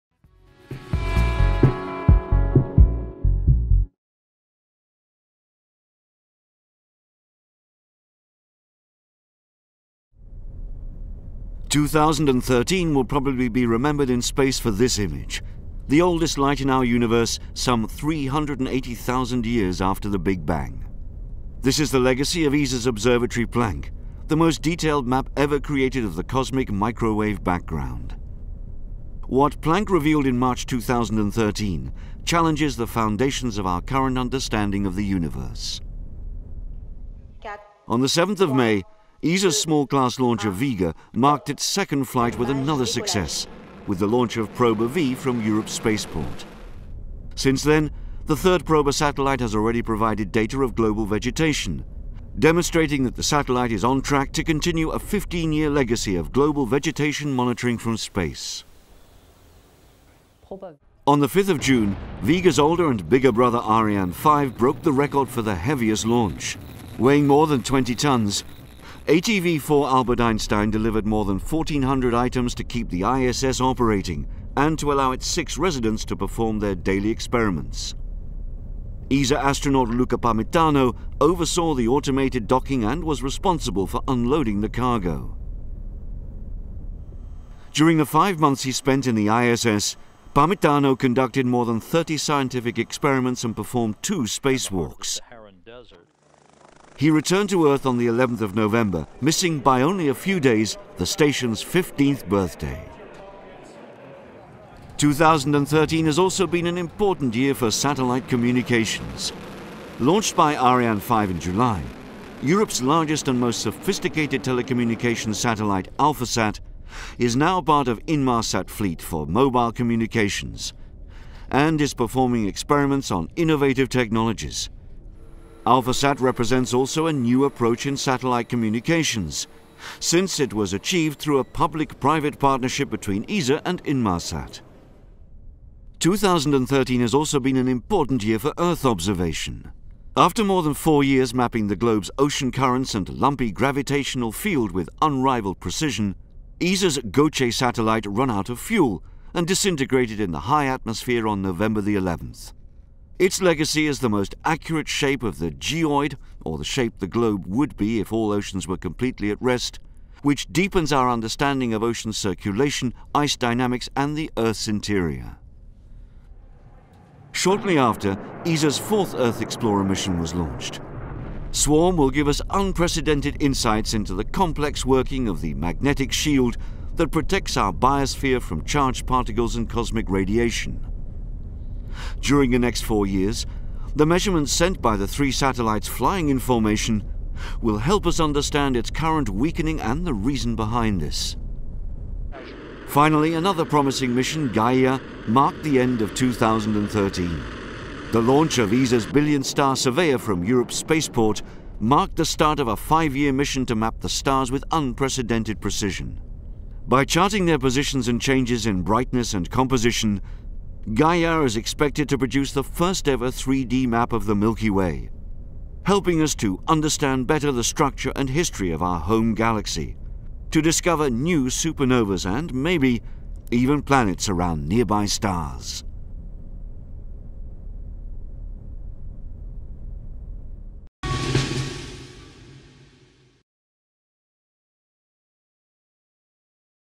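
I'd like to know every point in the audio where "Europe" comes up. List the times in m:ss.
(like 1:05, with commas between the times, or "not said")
0:45, 1:52, 3:20.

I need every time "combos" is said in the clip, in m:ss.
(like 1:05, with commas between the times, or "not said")
not said.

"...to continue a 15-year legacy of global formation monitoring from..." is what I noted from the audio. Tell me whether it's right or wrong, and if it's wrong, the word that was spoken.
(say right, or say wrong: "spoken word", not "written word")
wrong: "vegetation", not "formation".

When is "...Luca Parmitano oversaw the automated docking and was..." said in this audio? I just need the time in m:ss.
1:19.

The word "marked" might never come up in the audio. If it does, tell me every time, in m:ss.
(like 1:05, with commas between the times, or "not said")
0:41, 3:15, 3:21.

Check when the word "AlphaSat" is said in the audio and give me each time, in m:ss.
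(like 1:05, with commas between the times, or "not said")
1:55, 2:05.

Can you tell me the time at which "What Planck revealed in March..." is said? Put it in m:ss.
0:29.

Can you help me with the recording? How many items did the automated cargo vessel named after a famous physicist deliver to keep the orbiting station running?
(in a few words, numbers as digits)
more than 1,400.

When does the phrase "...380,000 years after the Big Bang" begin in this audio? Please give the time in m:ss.
0:17.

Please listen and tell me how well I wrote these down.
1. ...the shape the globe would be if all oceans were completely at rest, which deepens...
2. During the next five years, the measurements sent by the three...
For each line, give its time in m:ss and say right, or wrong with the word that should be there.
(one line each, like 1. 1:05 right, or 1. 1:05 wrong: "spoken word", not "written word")
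1. 2:36 right
2. 3:02 wrong: "four", not "five".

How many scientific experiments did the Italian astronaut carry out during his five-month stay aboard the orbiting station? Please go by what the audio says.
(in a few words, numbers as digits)
more than 30.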